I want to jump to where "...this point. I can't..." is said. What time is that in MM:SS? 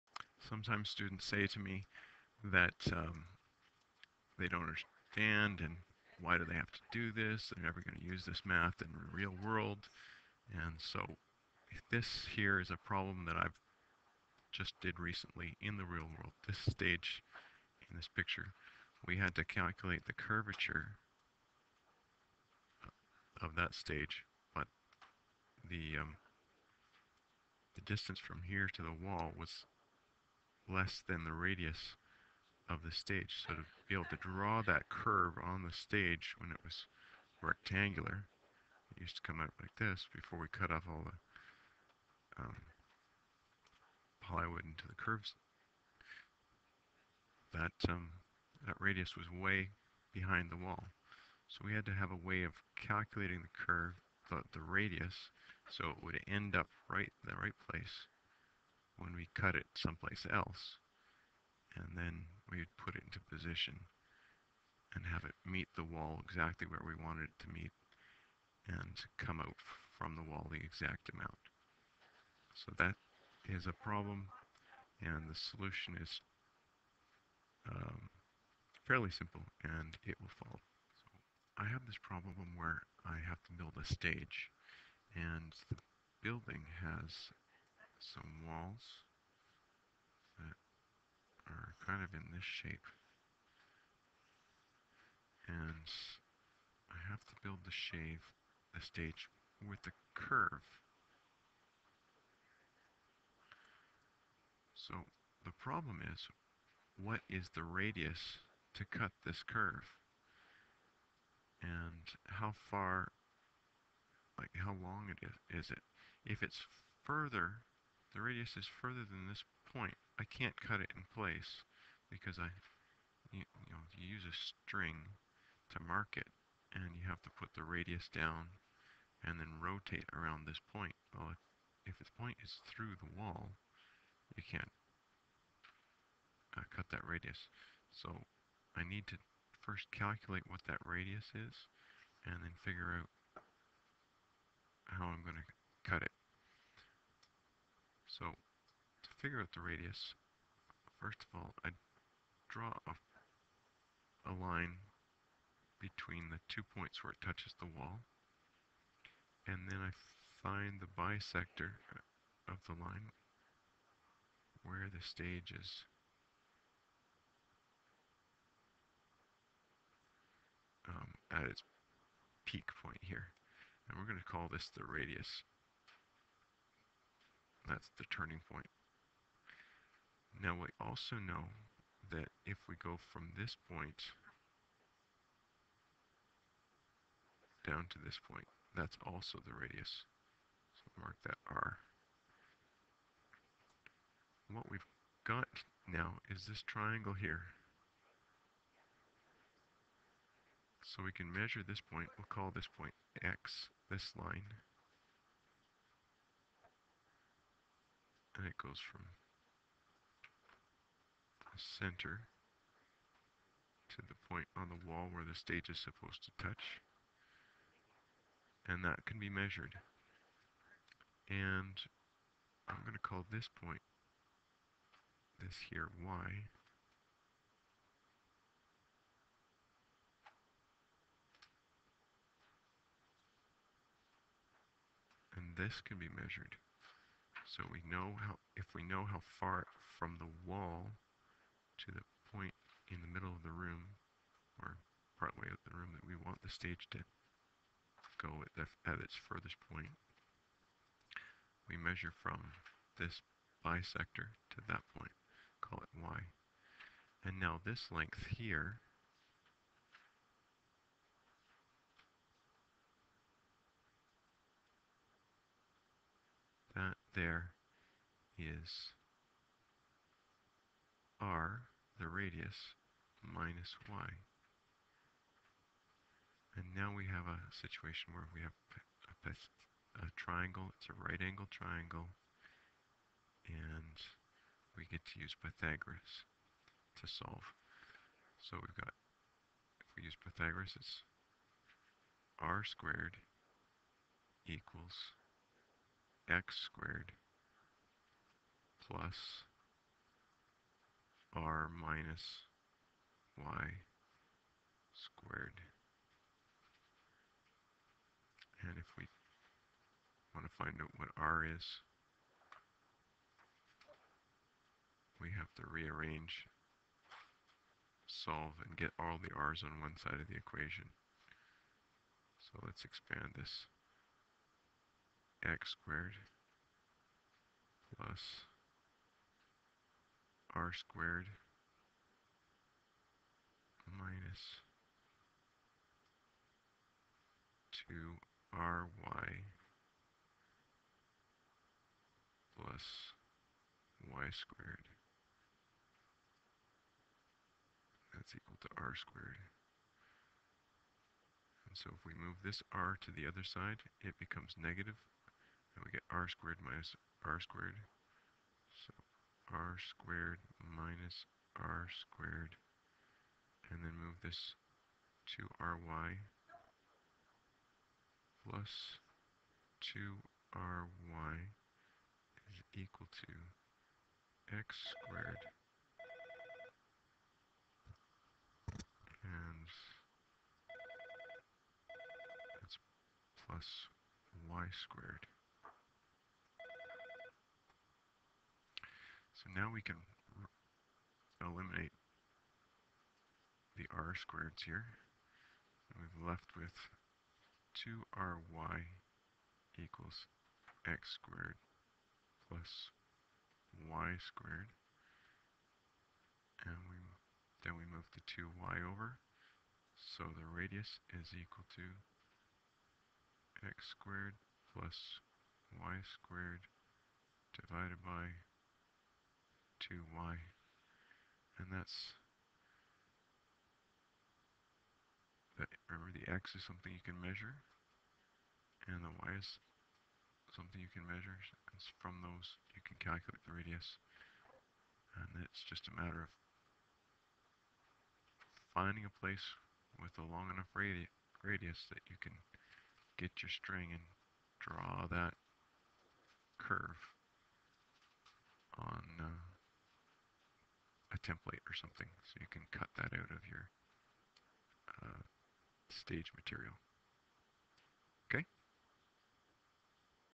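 01:59.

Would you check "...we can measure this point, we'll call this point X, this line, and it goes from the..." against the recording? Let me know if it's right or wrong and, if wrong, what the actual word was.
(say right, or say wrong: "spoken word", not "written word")
right.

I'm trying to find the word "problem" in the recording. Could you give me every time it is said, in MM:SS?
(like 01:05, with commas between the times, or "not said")
00:12, 01:13, 01:22, 01:45.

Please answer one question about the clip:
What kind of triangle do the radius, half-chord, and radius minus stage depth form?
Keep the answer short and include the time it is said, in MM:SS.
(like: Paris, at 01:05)
right angle triangle, at 04:40.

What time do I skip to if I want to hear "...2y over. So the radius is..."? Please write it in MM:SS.
06:48.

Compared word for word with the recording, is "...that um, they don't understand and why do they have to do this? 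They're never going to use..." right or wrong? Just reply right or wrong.
right.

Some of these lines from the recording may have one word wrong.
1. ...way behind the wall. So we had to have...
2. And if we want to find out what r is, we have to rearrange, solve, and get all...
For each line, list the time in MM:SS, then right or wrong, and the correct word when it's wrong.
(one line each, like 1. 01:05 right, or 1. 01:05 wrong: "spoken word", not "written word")
1. 00:49 right
2. 05:08 right.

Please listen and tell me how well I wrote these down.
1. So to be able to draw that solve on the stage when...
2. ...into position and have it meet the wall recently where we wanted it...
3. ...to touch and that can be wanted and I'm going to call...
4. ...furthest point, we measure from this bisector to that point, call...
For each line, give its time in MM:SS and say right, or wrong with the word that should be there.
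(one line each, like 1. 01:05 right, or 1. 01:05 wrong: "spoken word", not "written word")
1. 00:33 wrong: "curve", not "solve"
2. 01:03 wrong: "exactly", not "recently"
3. 03:36 wrong: "measured", not "wanted"
4. 04:09 right.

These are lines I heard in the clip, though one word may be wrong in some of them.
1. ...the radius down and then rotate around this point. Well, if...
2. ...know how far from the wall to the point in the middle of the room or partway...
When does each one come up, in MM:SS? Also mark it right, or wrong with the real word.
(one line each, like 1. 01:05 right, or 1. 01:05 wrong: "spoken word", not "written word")
1. 02:07 right
2. 03:58 right.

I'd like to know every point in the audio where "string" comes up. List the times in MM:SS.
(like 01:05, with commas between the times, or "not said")
02:04, 07:23.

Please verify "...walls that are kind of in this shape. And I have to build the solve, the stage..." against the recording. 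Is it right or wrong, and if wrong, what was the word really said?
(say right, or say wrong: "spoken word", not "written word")
wrong: "shave", not "solve".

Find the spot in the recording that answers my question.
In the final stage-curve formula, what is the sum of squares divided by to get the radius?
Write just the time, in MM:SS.
06:59.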